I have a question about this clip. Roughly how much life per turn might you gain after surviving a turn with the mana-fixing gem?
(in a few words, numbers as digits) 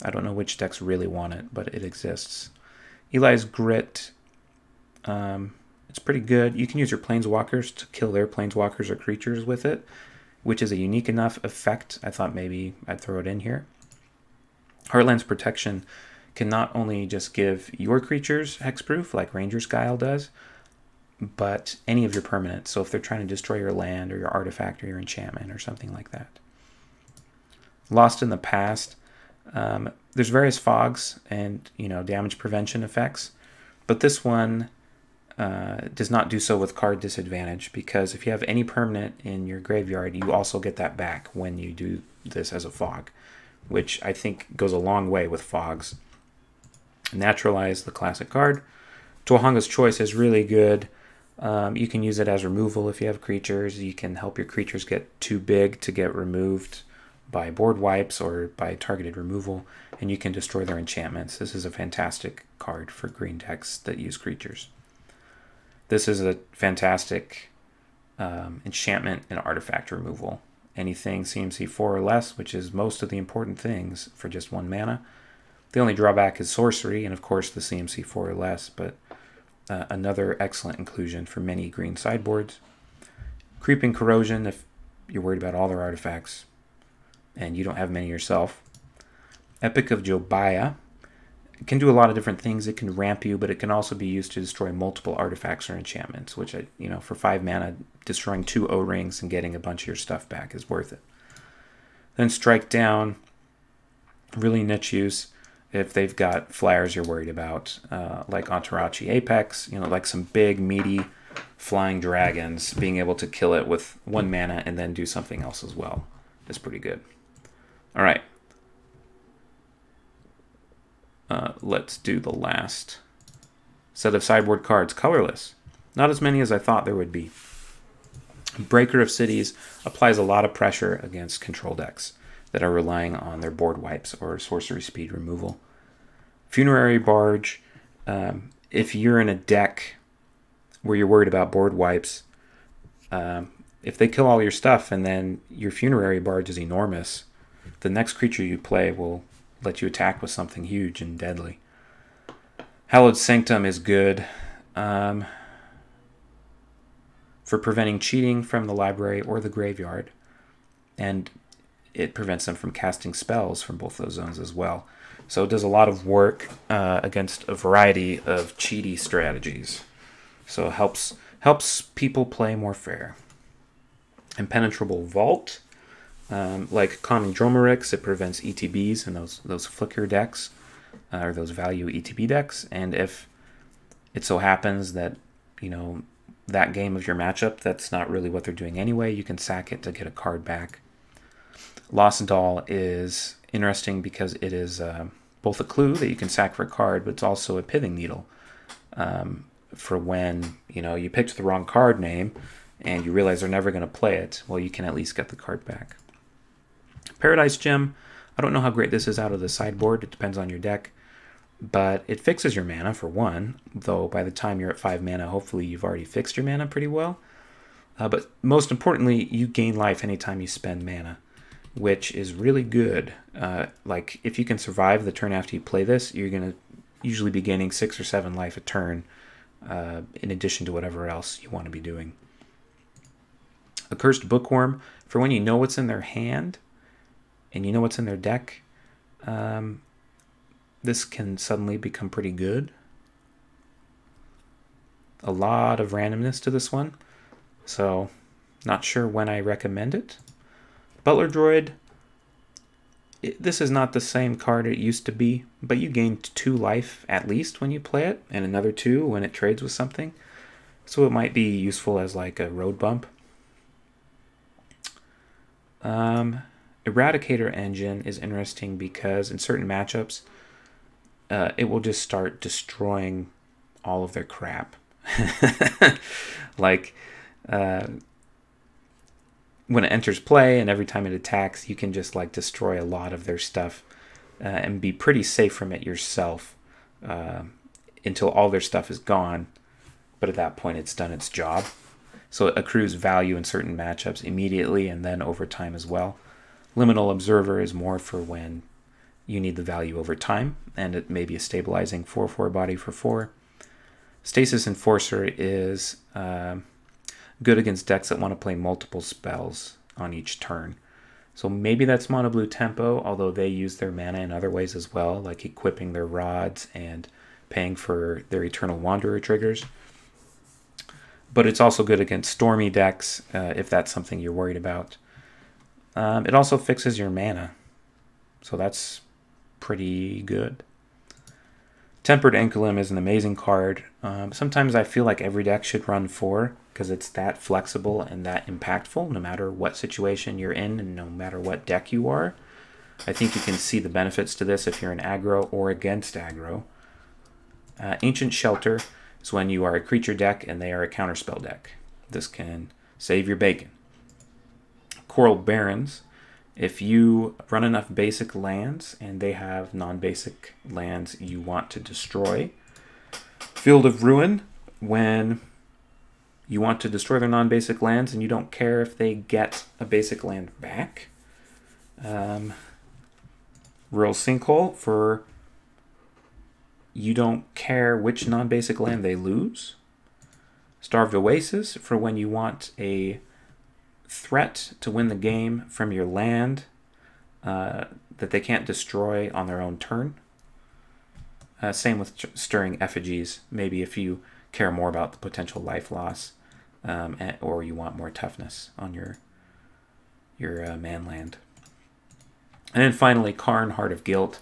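6 or 7.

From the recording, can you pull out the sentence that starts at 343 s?
I think you can see the benefits to this if you're an aggro or against aggro.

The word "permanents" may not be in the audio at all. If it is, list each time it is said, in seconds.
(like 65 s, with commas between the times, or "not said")
22 s, 38 s.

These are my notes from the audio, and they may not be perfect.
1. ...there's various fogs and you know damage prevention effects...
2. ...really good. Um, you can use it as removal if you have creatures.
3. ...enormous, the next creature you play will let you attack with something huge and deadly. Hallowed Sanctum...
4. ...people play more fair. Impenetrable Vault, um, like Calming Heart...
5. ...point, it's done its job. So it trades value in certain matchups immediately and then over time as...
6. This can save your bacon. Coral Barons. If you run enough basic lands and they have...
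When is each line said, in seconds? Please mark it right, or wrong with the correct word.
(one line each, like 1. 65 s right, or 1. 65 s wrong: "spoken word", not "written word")
1. 30 s right
2. 50 s right
3. 146 s right
4. 171 s wrong: "Dromerix", not "Heart"
5. 290 s wrong: "accrues", not "trades"
6. 352 s right.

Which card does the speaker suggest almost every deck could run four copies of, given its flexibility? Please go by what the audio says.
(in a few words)
Tempered Ankulum.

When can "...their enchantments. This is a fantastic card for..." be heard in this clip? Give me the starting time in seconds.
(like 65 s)
60 s.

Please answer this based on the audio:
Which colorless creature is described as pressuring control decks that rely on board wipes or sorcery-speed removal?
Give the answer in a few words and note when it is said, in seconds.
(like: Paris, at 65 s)
Breaker of Cities, at 128 s.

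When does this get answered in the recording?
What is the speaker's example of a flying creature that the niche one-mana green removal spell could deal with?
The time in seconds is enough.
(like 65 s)
108 s.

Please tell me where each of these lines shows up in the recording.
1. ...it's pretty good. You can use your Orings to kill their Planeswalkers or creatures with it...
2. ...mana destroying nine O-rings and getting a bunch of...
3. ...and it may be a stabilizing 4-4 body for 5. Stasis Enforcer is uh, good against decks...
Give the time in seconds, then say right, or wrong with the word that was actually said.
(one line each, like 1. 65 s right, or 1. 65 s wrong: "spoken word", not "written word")
1. 5 s wrong: "Planeswalkers", not "Orings"
2. 97 s wrong: "two", not "nine"
3. 300 s wrong: "4", not "5".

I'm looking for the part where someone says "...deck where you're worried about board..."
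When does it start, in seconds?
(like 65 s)
139 s.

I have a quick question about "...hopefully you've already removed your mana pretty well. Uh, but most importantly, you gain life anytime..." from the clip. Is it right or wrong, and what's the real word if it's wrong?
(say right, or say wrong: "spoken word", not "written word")
wrong: "fixed", not "removed".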